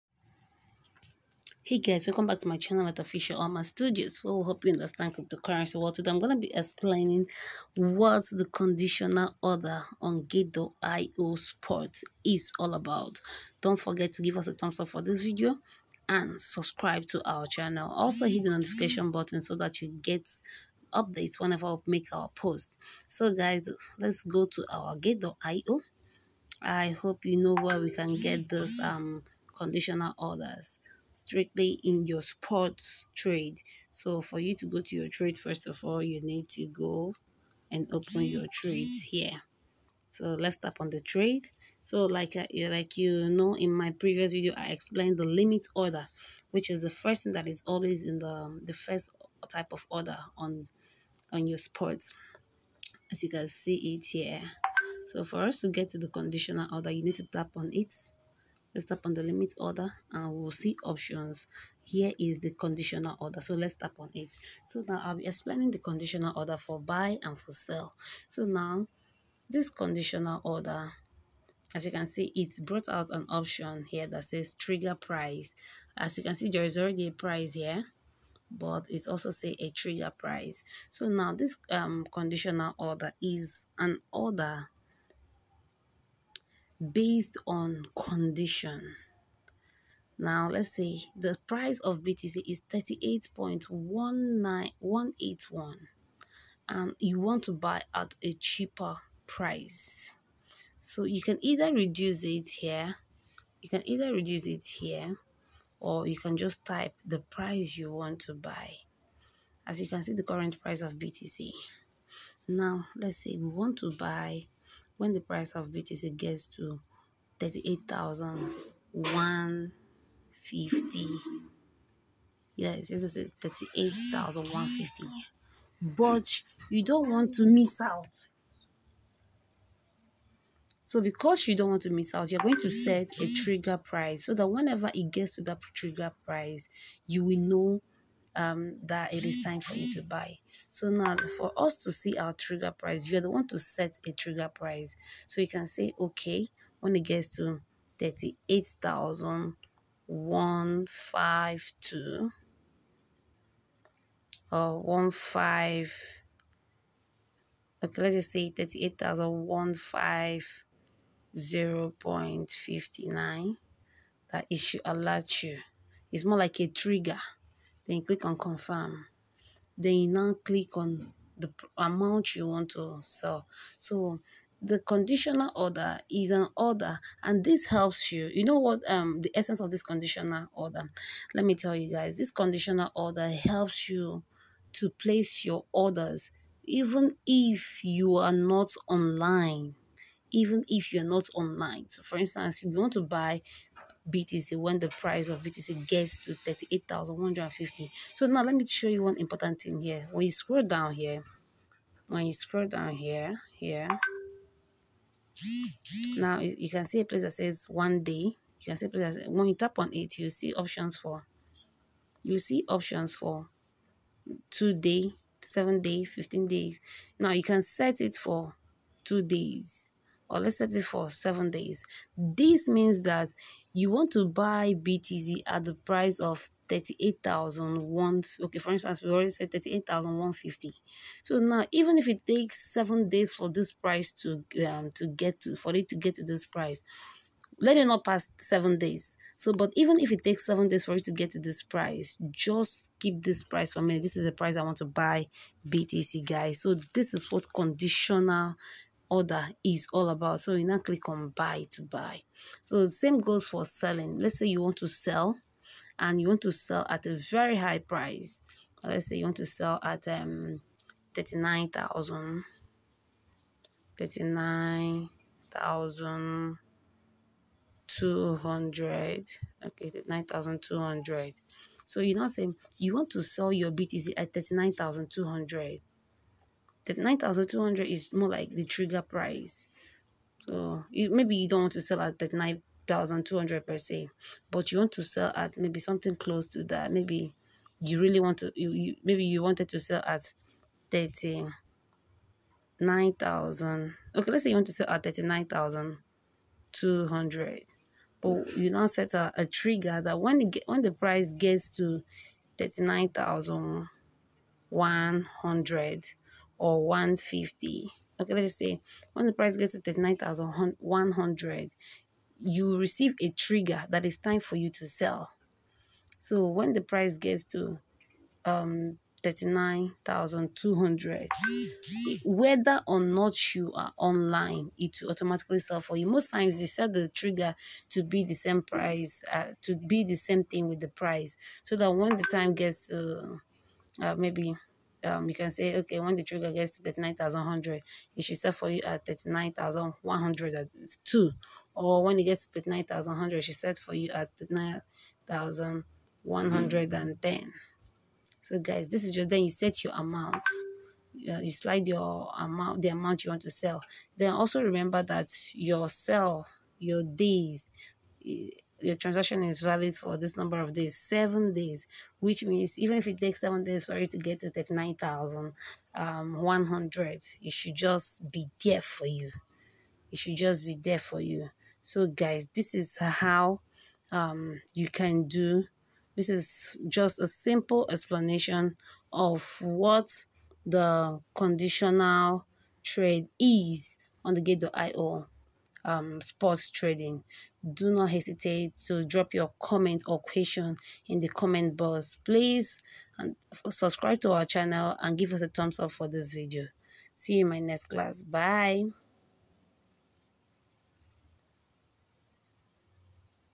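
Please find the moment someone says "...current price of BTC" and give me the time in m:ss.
1:50.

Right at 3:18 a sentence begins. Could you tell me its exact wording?
So now let me show you one important thing here.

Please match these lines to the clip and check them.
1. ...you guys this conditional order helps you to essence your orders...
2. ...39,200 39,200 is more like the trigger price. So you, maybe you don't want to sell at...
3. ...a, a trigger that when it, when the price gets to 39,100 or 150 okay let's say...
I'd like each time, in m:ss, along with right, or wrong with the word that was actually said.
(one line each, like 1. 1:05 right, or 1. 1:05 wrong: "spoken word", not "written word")
1. 3:01 wrong: "place", not "essence"
2. 4:34 right
3. 4:59 right.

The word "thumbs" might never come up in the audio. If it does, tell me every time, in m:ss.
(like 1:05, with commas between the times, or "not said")
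0:14, 6:35.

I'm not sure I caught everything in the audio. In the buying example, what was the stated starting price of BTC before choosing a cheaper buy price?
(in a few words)
38.19181.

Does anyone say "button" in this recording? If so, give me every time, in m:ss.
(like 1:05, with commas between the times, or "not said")
0:19.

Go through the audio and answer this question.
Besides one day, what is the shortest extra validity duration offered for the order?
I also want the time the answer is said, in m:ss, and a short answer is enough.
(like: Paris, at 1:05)
2 days, at 3:34.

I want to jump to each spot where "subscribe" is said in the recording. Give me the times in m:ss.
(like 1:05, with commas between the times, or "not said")
0:16, 6:33.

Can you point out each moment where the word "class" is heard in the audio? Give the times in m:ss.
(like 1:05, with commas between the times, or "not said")
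6:37.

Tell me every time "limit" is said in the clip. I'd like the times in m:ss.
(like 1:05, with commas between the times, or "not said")
0:45, 0:59.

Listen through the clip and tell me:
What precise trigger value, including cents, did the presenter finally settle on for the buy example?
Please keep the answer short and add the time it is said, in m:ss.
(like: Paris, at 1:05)
38,150.59, at 2:38.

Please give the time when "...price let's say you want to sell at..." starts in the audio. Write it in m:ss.
4:17.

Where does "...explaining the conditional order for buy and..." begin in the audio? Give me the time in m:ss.
1:05.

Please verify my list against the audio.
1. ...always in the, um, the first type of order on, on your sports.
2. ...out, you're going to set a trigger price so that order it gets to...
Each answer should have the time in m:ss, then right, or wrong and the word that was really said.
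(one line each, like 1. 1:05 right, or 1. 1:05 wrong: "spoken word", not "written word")
1. 0:47 right
2. 2:12 wrong: "whenever", not "order".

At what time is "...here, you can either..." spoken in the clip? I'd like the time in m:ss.
1:42.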